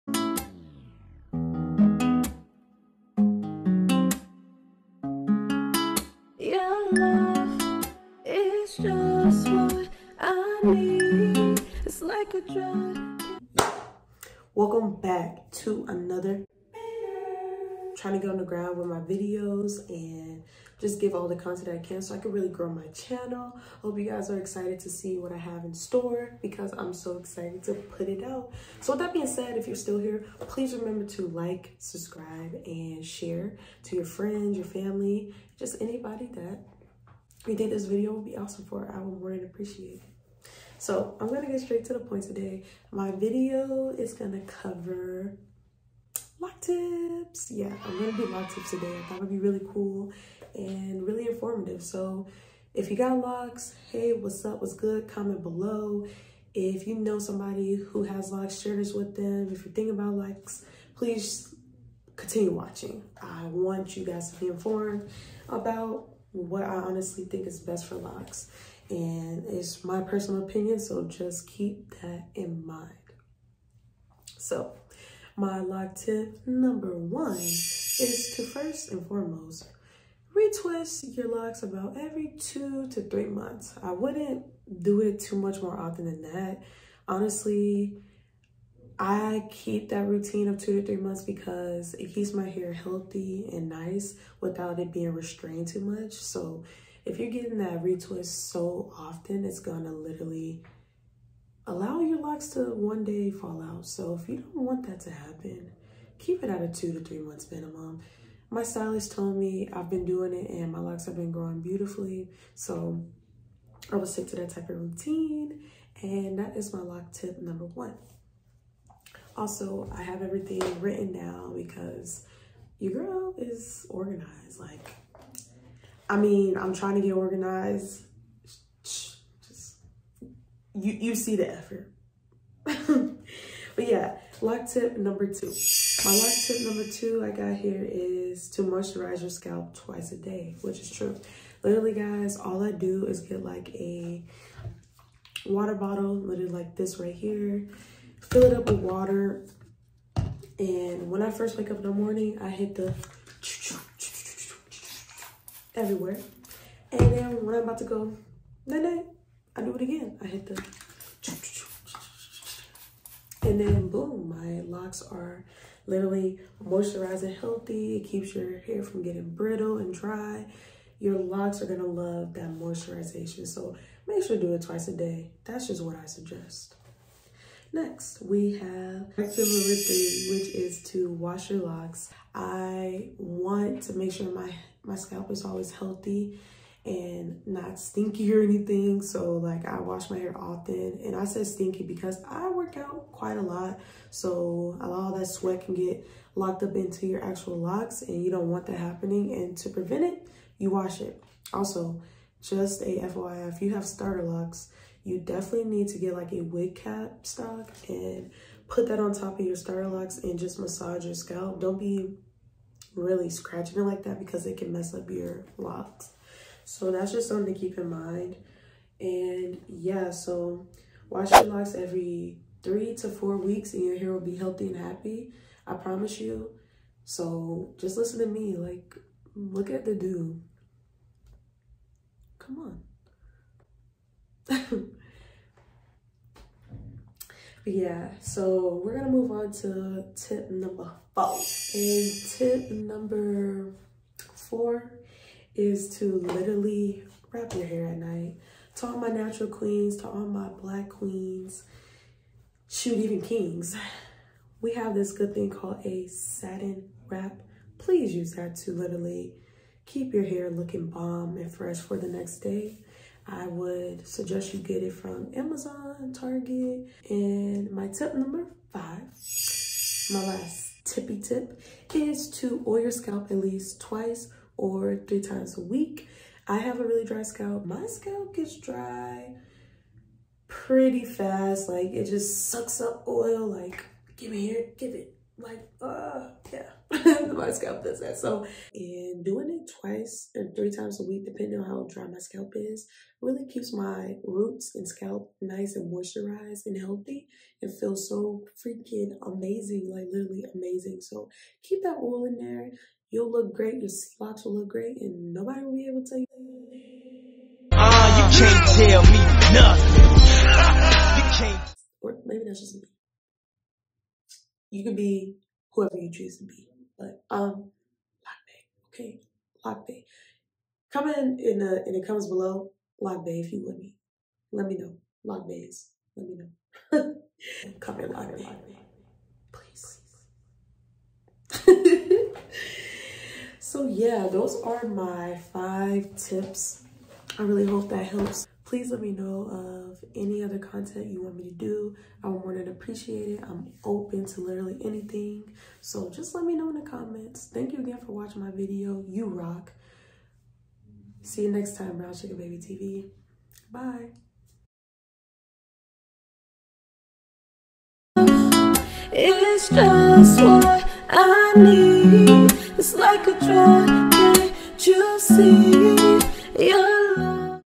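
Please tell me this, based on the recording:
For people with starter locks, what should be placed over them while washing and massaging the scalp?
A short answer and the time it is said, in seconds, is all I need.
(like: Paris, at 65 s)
wig cap, at 206 s.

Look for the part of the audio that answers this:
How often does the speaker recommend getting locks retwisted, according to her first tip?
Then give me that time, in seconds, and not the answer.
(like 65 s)
81 s.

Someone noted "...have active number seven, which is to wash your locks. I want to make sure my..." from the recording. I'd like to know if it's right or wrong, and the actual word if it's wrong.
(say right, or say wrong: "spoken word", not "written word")
wrong: "three", not "seven".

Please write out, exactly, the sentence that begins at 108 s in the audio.
My stylist told me I've been doing it and my locks have been growing beautifully.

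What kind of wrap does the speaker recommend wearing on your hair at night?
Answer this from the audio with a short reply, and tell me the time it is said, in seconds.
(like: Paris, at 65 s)
satin wrap, at 256 s.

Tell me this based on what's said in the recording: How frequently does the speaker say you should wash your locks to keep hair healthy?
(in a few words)
every 3 to 4 weeks.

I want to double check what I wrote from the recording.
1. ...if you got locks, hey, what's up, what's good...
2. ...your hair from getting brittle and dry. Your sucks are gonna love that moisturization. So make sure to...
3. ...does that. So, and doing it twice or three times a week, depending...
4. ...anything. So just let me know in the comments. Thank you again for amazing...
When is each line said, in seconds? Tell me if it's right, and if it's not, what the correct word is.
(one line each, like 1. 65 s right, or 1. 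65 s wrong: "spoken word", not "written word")
1. 52 s right
2. 168 s wrong: "locks", not "sucks"
3. 287 s right
4. 344 s wrong: "watching", not "amazing".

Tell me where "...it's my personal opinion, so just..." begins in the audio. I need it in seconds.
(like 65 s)
69 s.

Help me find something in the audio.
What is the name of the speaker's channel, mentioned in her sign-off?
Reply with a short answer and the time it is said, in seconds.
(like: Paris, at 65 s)
Brown Sugar Baby TV, at 351 s.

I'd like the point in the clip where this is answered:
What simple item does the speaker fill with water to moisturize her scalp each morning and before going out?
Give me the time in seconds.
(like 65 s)
145 s.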